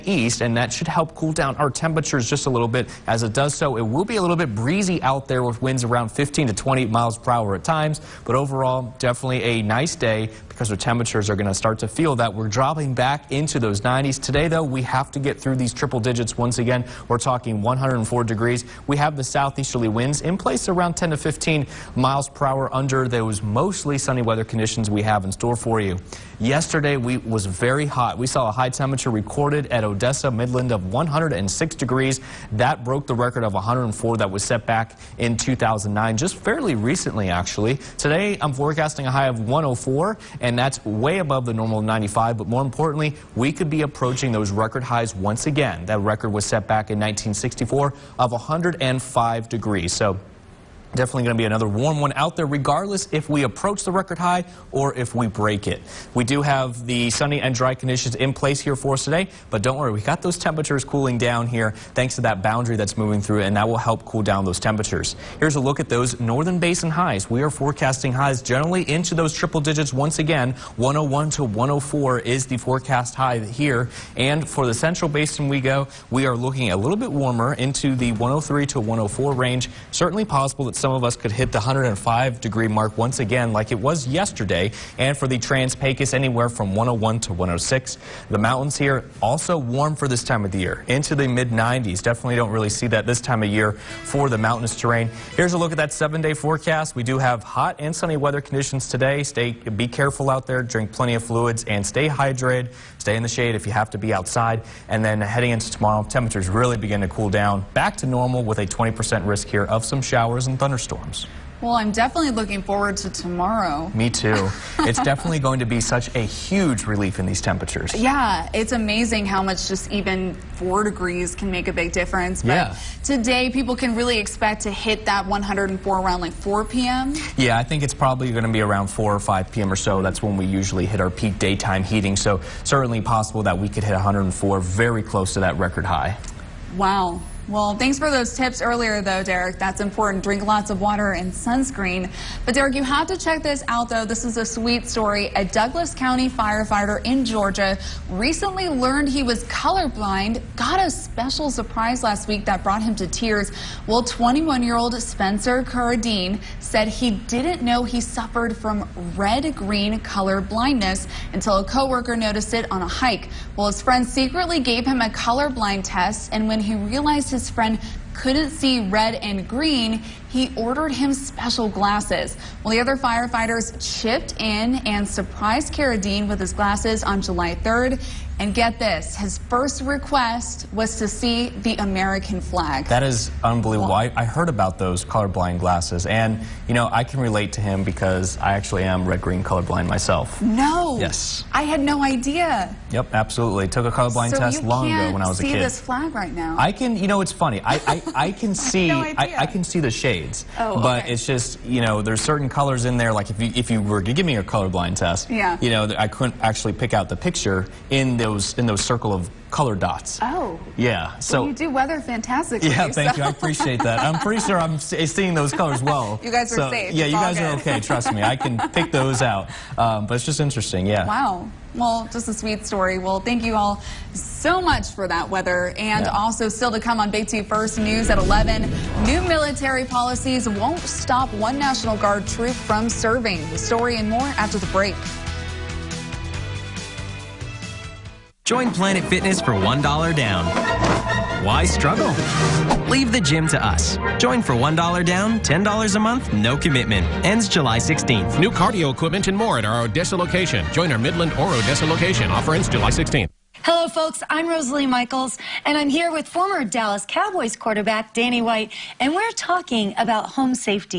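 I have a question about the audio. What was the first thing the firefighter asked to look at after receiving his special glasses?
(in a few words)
American flag.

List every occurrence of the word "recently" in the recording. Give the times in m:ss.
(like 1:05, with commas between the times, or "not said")
0:36, 2:28.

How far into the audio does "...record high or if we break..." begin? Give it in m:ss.
0:53.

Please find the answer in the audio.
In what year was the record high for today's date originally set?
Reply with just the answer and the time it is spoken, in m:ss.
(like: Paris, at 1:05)
1964, at 0:46.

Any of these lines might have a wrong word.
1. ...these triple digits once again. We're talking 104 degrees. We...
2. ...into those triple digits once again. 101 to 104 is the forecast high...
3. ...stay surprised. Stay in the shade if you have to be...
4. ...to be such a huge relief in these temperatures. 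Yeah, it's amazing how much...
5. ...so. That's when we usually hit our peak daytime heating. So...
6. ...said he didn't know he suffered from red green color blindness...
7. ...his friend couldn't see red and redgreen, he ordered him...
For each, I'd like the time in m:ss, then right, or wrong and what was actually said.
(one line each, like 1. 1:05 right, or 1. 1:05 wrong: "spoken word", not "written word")
1. 0:15 right
2. 1:08 right
3. 1:41 wrong: "hydrated", not "surprised"
4. 1:55 right
5. 2:09 right
6. 2:36 right
7. 2:47 wrong: "green", not "redgreen".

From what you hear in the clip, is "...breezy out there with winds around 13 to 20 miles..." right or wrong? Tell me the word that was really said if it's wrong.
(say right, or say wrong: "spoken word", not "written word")
wrong: "15", not "13".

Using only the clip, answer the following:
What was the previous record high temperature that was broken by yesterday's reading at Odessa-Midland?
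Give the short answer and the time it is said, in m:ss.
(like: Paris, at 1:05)
104, at 0:33.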